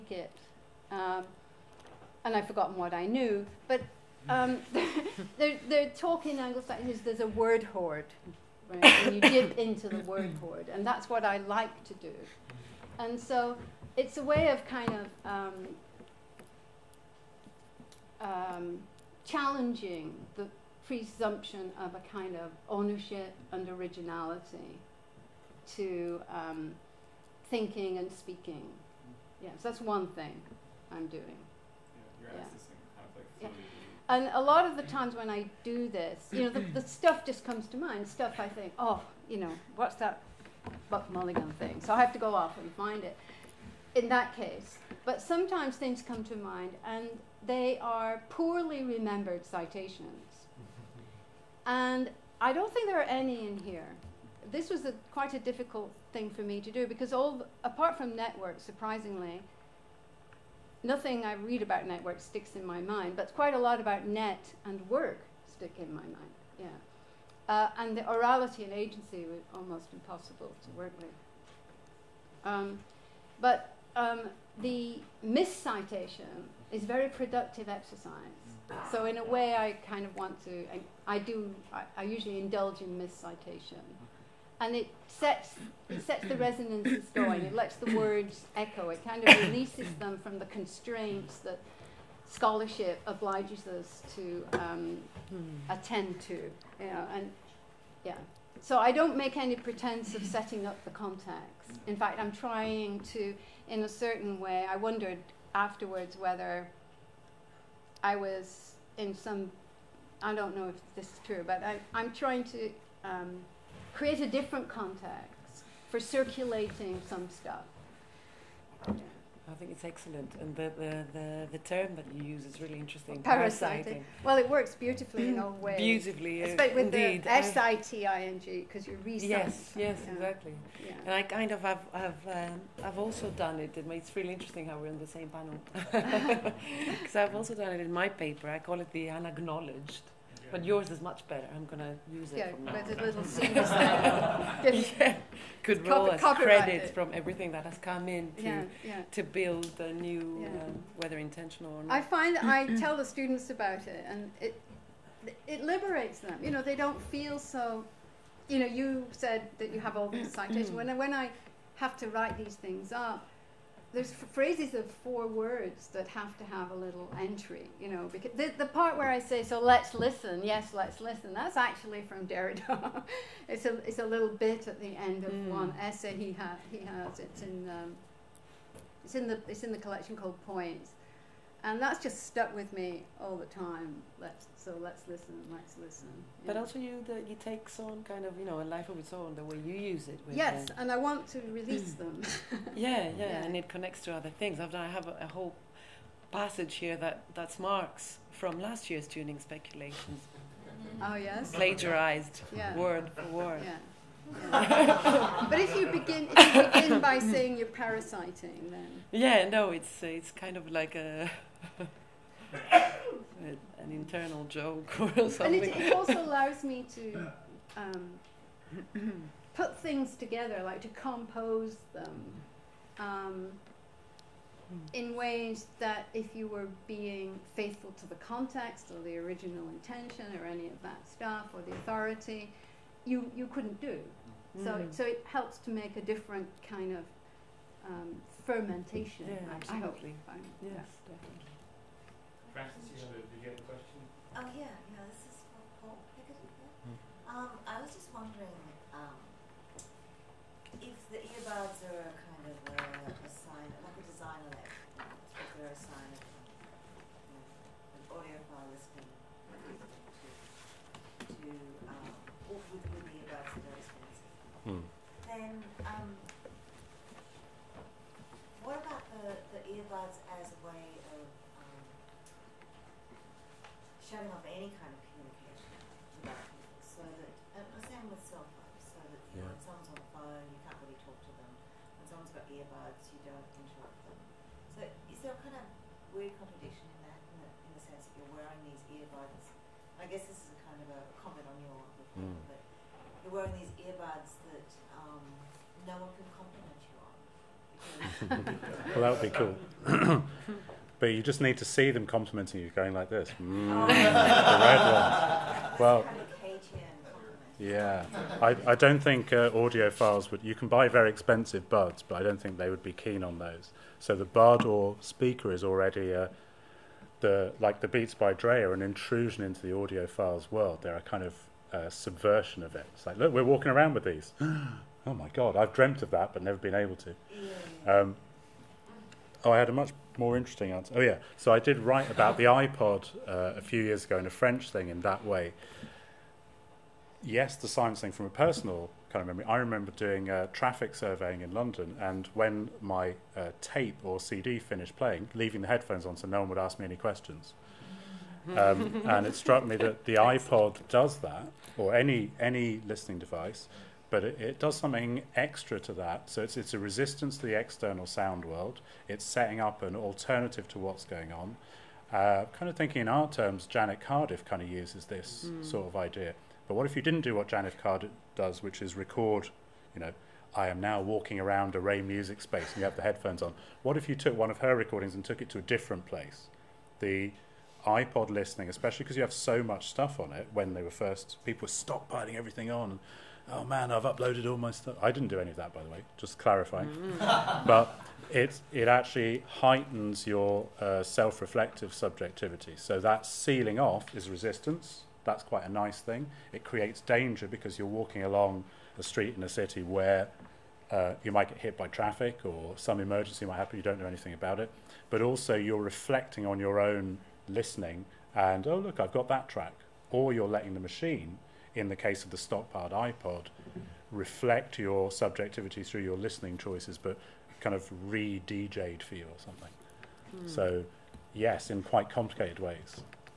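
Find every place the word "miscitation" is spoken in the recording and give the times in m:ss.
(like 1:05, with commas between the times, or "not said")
1:15, 1:22.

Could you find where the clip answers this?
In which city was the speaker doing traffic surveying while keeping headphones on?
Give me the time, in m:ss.
5:41.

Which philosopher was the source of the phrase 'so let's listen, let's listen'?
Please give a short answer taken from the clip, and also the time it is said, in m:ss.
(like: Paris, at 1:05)
Derrida, at 2:52.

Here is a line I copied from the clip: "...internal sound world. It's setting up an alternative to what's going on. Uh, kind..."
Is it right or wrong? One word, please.
wrong.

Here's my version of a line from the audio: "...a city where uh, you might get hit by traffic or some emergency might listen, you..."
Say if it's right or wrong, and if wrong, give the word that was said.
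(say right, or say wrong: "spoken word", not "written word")
wrong: "happen", not "listen".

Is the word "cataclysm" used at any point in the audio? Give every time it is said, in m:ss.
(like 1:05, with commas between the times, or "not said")
not said.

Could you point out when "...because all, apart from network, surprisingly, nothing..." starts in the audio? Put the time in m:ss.
0:56.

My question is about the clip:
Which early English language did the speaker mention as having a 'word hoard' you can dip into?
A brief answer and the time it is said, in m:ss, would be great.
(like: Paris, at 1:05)
Anglo Saxon, at 0:06.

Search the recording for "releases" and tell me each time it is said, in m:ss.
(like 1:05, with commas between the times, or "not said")
1:29, 3:11.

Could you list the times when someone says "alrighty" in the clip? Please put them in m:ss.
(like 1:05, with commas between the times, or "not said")
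not said.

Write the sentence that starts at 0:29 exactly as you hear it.
Yes, yeah, so that's one thing I'm doing.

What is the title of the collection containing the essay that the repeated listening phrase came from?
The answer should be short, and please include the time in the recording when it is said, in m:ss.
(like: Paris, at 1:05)
Points, at 3:00.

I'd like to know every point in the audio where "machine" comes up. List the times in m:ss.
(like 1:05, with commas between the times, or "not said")
6:50.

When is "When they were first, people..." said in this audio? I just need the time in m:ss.
6:20.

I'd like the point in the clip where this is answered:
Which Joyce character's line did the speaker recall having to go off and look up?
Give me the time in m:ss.
0:40.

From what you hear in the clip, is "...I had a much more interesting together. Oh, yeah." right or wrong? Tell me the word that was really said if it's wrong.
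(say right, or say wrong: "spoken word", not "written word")
wrong: "answer", not "together".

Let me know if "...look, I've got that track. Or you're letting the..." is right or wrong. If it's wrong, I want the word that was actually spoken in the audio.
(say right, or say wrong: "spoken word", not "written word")
right.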